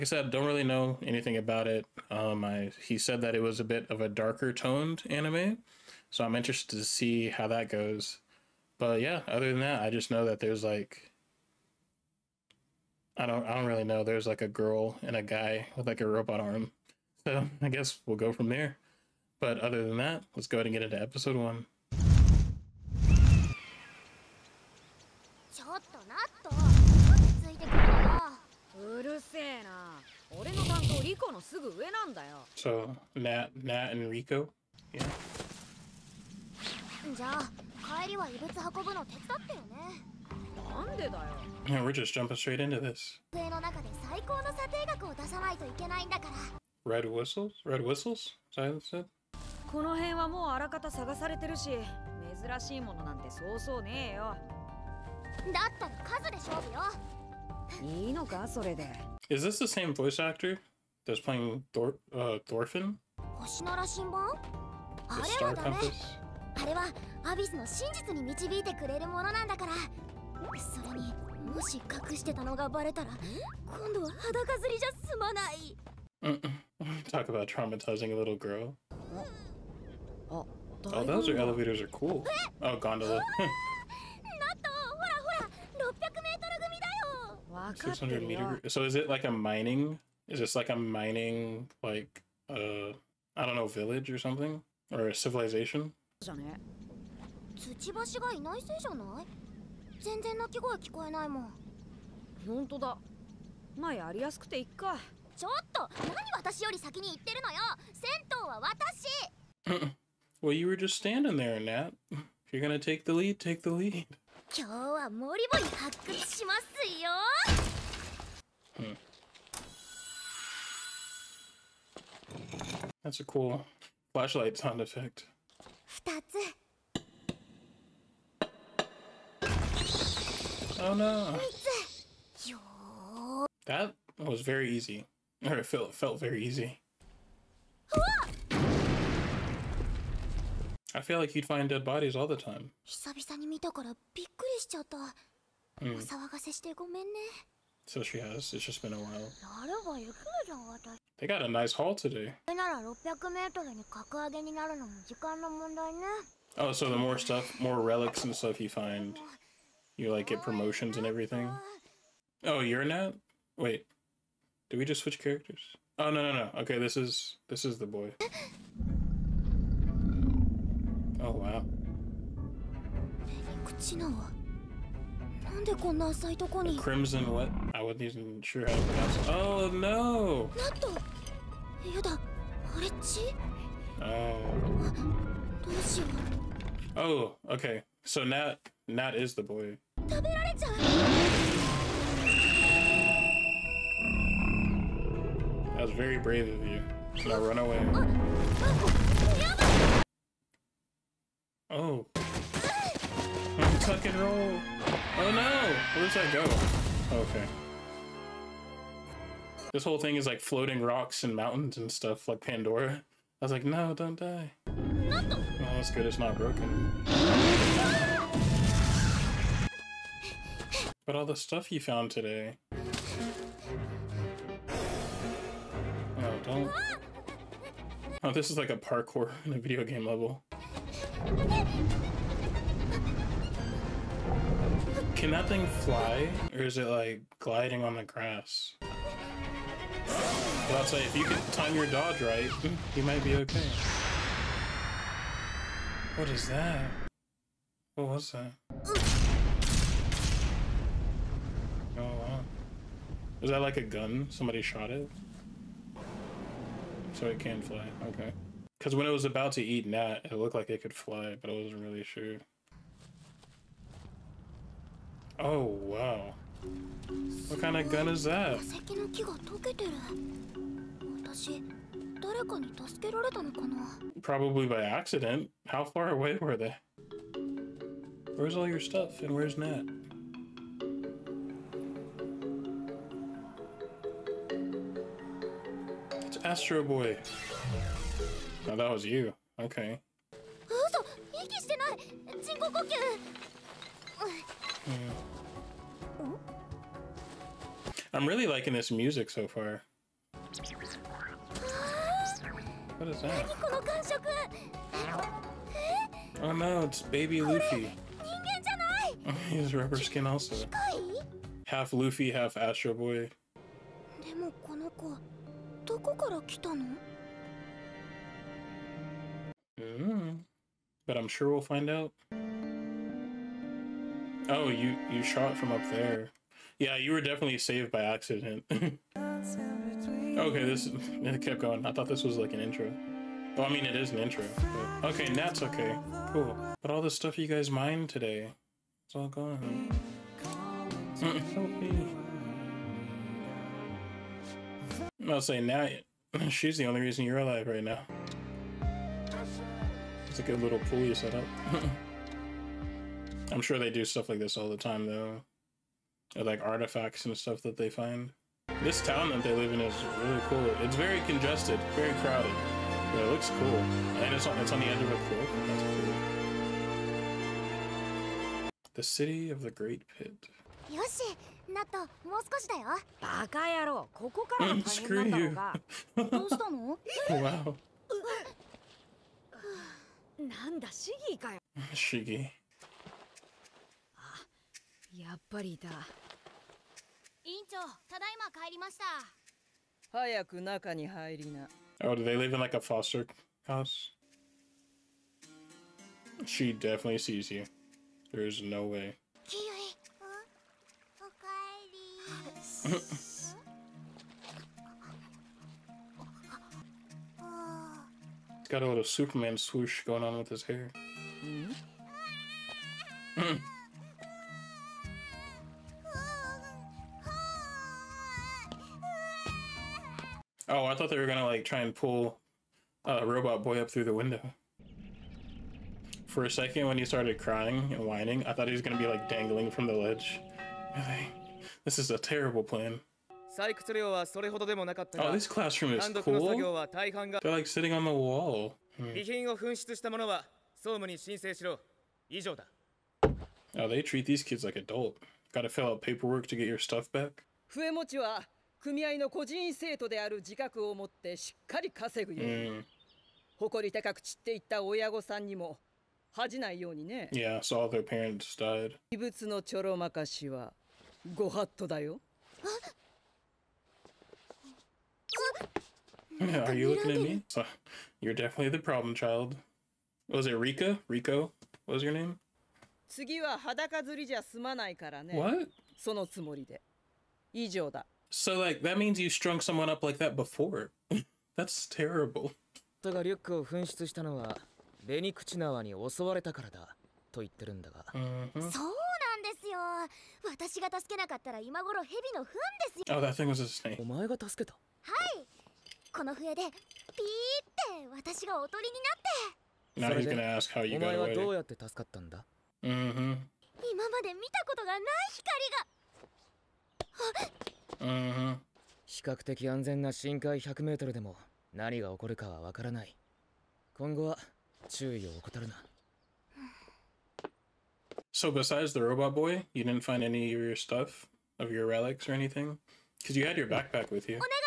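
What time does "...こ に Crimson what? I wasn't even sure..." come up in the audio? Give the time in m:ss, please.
2:56.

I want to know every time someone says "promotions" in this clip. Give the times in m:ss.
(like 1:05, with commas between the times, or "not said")
2:40.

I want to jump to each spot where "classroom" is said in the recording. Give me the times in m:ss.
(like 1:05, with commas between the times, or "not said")
7:15.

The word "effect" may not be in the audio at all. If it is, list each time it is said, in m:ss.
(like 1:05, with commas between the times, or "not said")
2:04.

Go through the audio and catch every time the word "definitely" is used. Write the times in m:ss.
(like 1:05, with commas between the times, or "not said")
5:27, 6:36, 7:48.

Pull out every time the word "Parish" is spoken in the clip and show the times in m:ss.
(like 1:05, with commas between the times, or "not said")
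not said.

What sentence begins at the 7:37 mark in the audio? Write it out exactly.
Yeah, so all their parents died.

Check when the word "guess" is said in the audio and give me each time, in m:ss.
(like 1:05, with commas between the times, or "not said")
0:17.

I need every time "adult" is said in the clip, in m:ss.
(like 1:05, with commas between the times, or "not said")
7:24.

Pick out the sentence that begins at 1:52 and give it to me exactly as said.
If you're gonna take the lead, take the lead.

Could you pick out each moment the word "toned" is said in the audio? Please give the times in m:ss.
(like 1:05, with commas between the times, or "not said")
0:04.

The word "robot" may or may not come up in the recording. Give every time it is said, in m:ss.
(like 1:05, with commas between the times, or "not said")
0:16, 7:03, 8:39.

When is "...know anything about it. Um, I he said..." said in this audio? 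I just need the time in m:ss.
0:00.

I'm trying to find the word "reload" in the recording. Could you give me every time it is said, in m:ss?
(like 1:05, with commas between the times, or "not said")
not said.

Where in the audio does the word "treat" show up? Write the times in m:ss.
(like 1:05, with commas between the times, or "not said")
7:24.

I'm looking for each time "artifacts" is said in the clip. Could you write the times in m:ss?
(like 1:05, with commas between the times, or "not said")
5:56.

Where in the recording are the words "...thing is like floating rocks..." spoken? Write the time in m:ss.
3:29.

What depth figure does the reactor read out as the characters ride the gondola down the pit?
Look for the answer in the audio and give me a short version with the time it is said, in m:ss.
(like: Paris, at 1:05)
600 meter, at 1:27.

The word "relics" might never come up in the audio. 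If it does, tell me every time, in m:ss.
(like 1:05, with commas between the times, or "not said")
2:37, 8:41.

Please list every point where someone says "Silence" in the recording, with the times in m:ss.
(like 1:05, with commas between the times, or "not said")
0:48.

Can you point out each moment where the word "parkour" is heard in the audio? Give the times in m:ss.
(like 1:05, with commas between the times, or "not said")
3:48.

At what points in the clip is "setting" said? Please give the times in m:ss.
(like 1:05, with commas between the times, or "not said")
not said.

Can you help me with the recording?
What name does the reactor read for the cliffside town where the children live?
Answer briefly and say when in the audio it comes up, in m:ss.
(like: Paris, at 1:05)
The city of the Great Pit, at 6:08.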